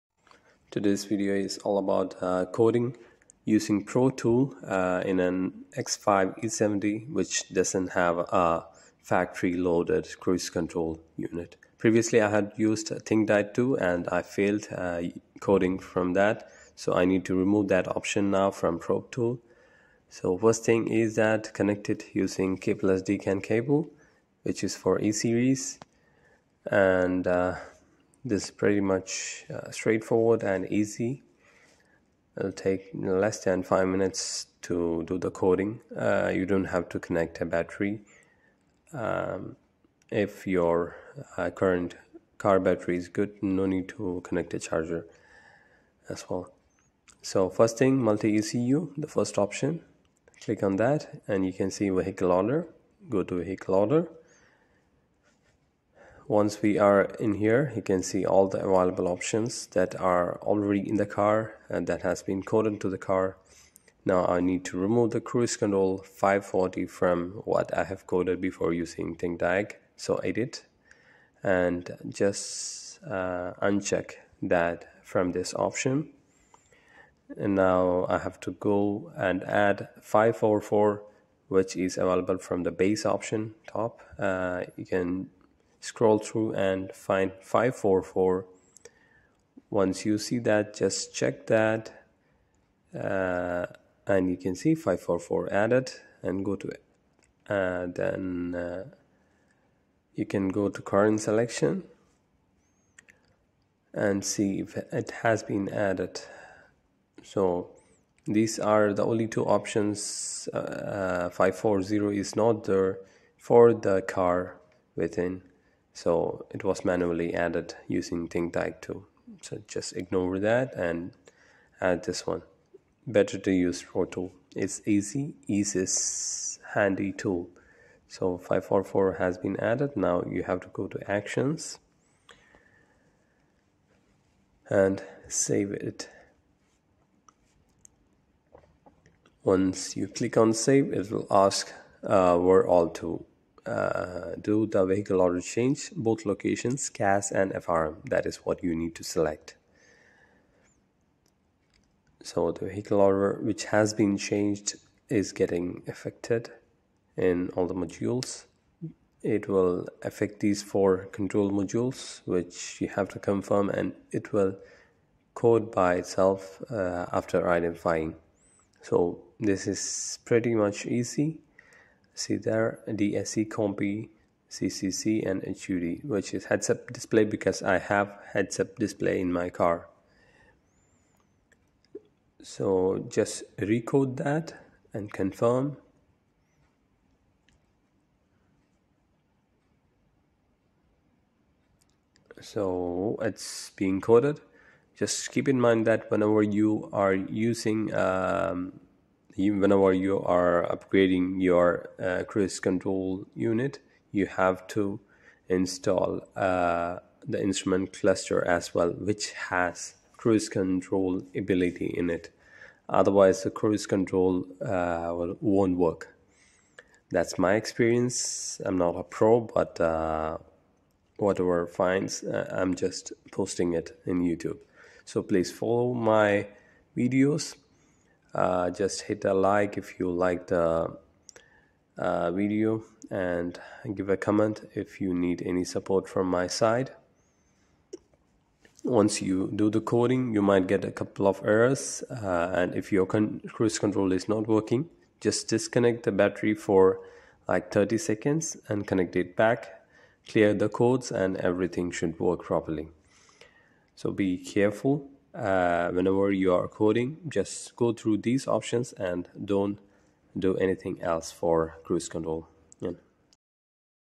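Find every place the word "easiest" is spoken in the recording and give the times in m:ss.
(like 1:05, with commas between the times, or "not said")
2:05.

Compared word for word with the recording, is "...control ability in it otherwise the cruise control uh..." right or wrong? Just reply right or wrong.
right.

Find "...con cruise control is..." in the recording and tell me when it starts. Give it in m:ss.
4:03.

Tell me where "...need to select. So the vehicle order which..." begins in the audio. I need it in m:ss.
2:28.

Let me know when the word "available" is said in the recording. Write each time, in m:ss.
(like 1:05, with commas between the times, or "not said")
0:58, 1:21.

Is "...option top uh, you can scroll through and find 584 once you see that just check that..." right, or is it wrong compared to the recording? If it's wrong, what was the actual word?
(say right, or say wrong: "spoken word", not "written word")
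wrong: "544", not "584".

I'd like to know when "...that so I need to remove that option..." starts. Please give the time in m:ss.
0:16.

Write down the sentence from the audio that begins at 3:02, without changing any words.
So just recode that and confirm.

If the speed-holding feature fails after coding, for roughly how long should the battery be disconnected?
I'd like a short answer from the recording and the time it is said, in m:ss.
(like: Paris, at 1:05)
30 seconds, at 4:07.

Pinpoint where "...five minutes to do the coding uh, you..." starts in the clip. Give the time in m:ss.
0:33.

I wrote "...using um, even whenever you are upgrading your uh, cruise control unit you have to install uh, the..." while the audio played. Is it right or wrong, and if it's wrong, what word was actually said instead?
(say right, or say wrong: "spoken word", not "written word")
right.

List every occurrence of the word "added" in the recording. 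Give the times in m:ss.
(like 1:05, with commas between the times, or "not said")
1:35, 1:45, 1:57, 2:09.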